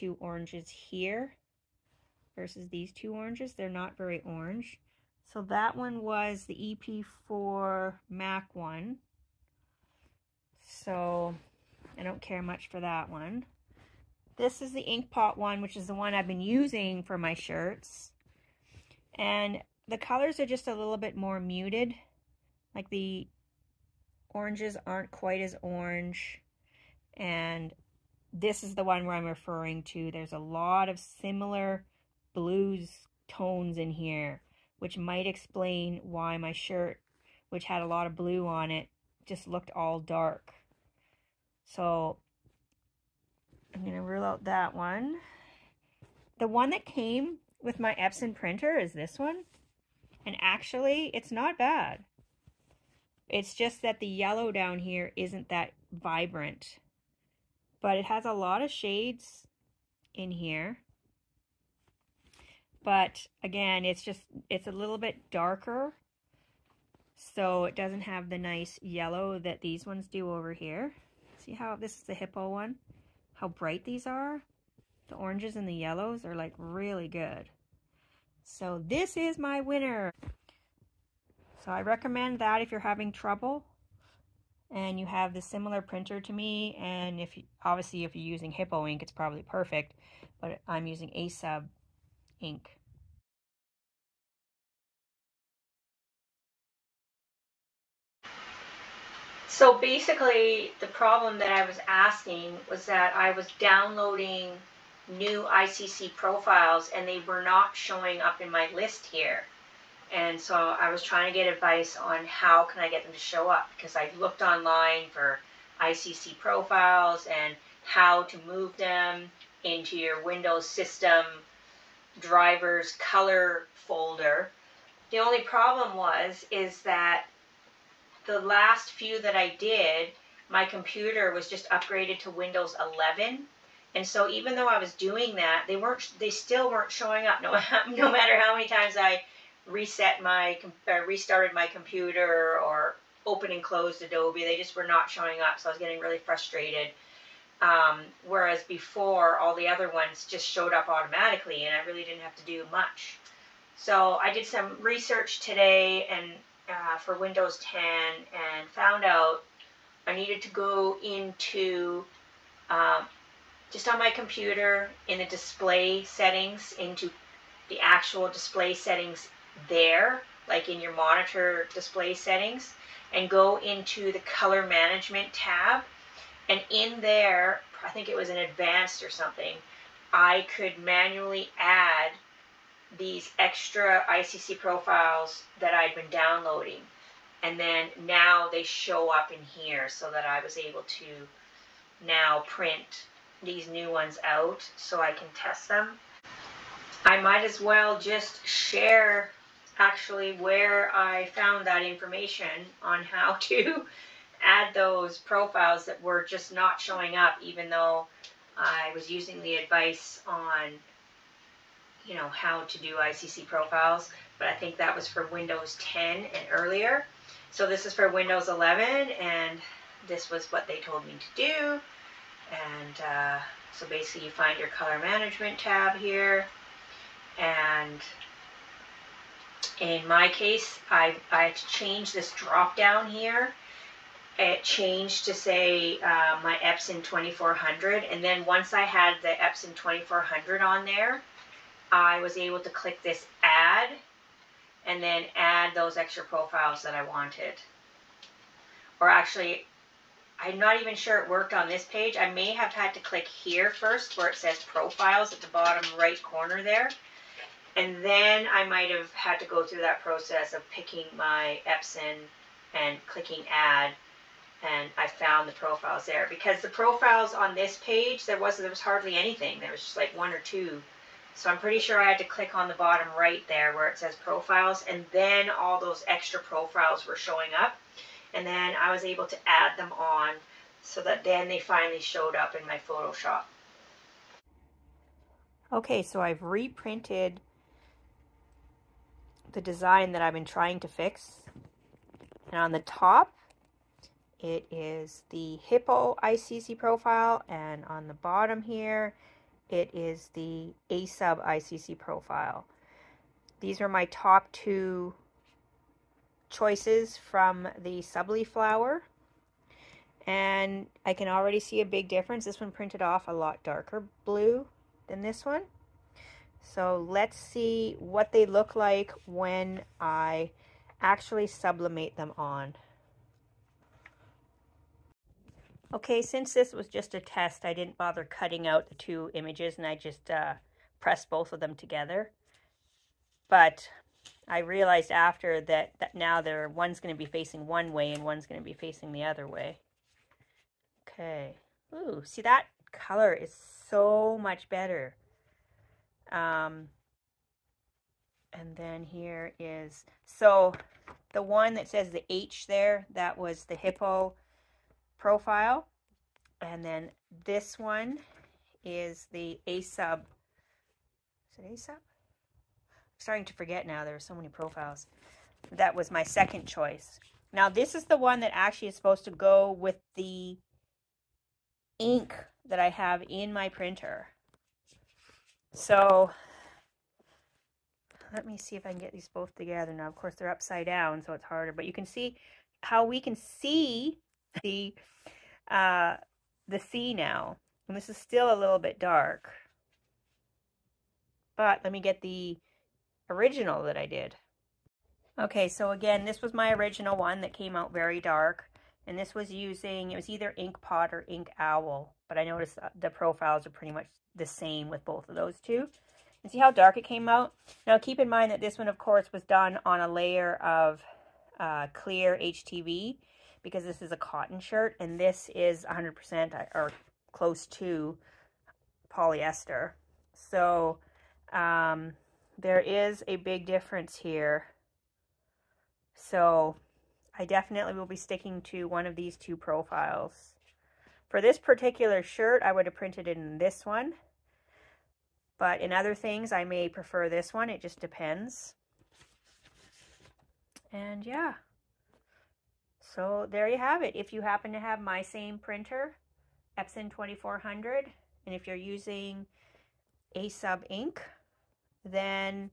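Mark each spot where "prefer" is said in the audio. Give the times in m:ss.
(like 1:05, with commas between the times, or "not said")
7:16.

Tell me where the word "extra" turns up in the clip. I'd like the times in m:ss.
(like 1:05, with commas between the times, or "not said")
3:03, 4:05, 4:36.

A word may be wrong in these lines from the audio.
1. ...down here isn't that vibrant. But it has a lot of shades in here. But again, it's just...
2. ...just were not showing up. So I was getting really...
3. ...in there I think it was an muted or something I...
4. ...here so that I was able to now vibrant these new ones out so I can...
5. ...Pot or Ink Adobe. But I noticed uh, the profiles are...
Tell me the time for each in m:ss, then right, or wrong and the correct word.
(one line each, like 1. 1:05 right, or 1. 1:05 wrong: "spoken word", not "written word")
1. 0:54 right
2. 2:24 right
3. 2:56 wrong: "advanced", not "muted"
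4. 3:09 wrong: "print", not "vibrant"
5. 6:40 wrong: "Owl", not "Adobe".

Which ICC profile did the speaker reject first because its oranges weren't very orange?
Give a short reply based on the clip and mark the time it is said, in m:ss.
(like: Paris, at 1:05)
EP4 MAC, at 0:07.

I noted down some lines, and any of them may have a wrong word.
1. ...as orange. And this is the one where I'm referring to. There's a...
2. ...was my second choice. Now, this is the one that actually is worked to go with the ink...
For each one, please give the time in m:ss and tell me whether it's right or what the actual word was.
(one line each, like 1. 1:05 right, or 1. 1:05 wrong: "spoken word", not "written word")
1. 0:25 right
2. 6:05 wrong: "supposed", not "worked".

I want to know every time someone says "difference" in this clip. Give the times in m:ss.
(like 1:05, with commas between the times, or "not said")
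5:12, 7:03.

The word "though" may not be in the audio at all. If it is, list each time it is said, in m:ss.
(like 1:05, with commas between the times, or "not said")
2:14, 3:27.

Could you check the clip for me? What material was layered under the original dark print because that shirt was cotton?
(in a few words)
clear HTV.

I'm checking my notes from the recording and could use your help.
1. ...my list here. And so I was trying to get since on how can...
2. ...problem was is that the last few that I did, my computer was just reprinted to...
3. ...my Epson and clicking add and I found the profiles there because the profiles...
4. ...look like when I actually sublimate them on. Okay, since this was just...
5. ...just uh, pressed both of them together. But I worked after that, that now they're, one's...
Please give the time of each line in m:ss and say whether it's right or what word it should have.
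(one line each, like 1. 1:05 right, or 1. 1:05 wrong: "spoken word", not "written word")
1. 1:48 wrong: "advice", not "since"
2. 2:05 wrong: "upgraded", not "reprinted"
3. 4:21 right
4. 5:18 right
5. 5:29 wrong: "realized", not "worked".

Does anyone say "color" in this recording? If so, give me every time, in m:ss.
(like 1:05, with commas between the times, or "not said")
0:19, 2:02, 2:54, 3:44, 5:42.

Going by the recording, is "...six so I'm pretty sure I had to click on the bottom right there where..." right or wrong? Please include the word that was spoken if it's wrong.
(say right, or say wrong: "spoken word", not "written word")
wrong: "two", not "six".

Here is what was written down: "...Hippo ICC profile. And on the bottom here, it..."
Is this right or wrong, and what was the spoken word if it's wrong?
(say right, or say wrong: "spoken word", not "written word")
right.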